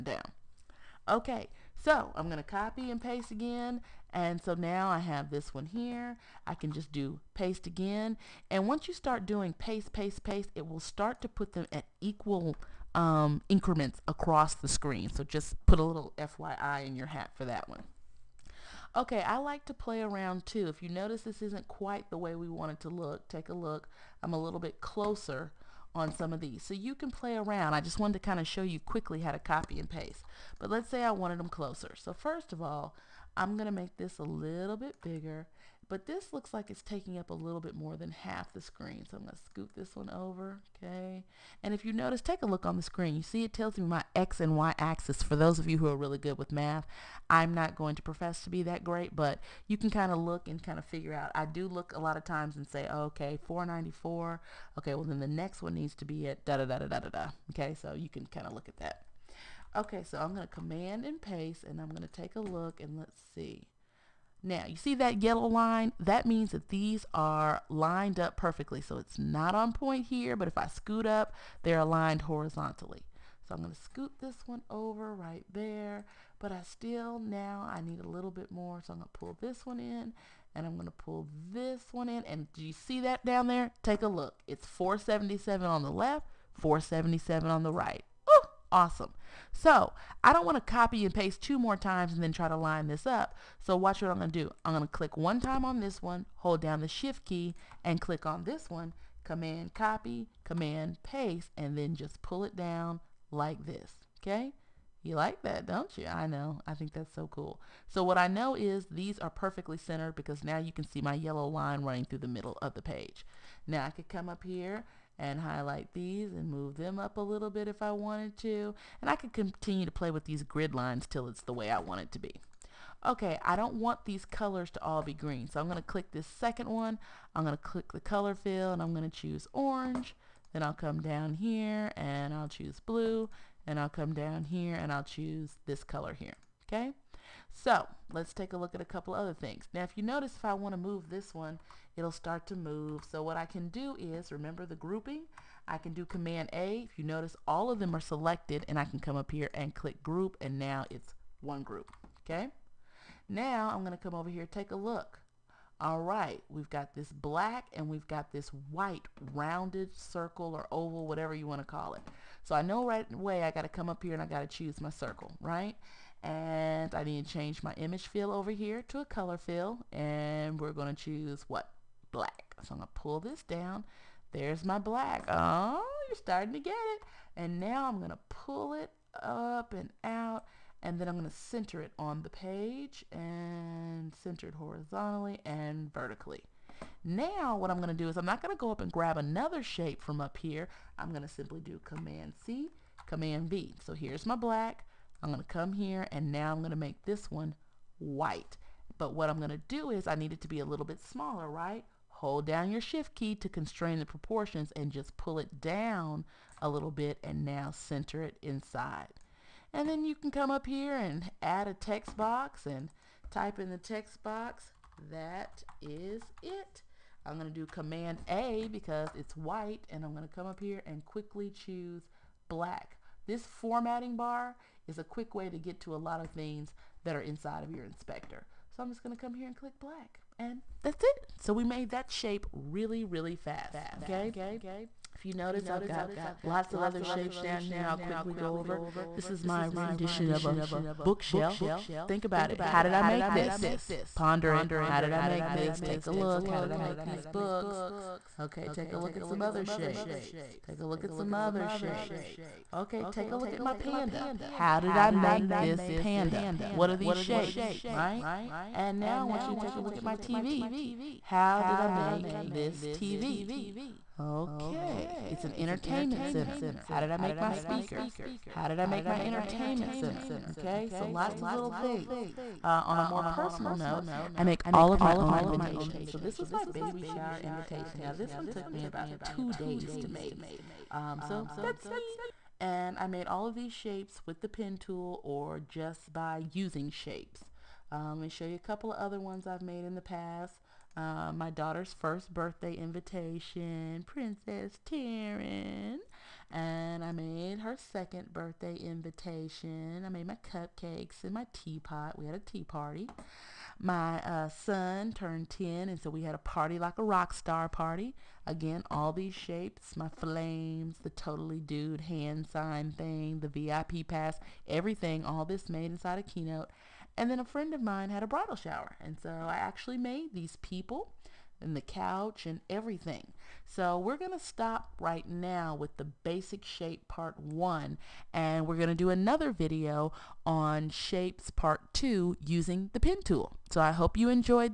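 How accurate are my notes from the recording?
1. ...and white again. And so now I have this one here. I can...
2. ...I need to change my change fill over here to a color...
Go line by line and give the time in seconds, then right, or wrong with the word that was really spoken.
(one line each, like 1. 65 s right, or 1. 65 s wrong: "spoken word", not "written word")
1. 2 s wrong: "paste", not "white"
2. 166 s wrong: "image", not "change".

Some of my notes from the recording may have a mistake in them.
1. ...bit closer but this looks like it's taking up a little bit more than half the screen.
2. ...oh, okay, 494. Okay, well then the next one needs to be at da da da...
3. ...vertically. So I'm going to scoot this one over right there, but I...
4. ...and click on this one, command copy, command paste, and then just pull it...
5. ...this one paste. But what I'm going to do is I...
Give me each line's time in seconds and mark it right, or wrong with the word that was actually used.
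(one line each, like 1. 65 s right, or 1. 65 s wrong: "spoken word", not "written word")
1. 34 s wrong: "bigger", not "closer"
2. 52 s right
3. 72 s wrong: "horizontally", not "vertically"
4. 97 s right
5. 197 s wrong: "white", not "paste".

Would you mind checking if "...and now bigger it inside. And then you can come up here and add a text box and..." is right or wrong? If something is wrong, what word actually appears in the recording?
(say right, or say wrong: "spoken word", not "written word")
wrong: "center", not "bigger".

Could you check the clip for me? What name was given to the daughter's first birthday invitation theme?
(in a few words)
Princess Taryn.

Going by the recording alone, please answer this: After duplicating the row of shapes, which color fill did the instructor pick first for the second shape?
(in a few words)
Orange.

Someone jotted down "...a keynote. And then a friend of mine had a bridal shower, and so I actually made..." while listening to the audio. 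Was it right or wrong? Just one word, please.
right.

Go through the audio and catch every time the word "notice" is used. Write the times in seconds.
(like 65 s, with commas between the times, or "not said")
20 s, 41 s, 140 s, 147 s, 235 s.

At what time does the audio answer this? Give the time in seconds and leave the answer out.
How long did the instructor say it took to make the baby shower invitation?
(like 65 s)
278 s.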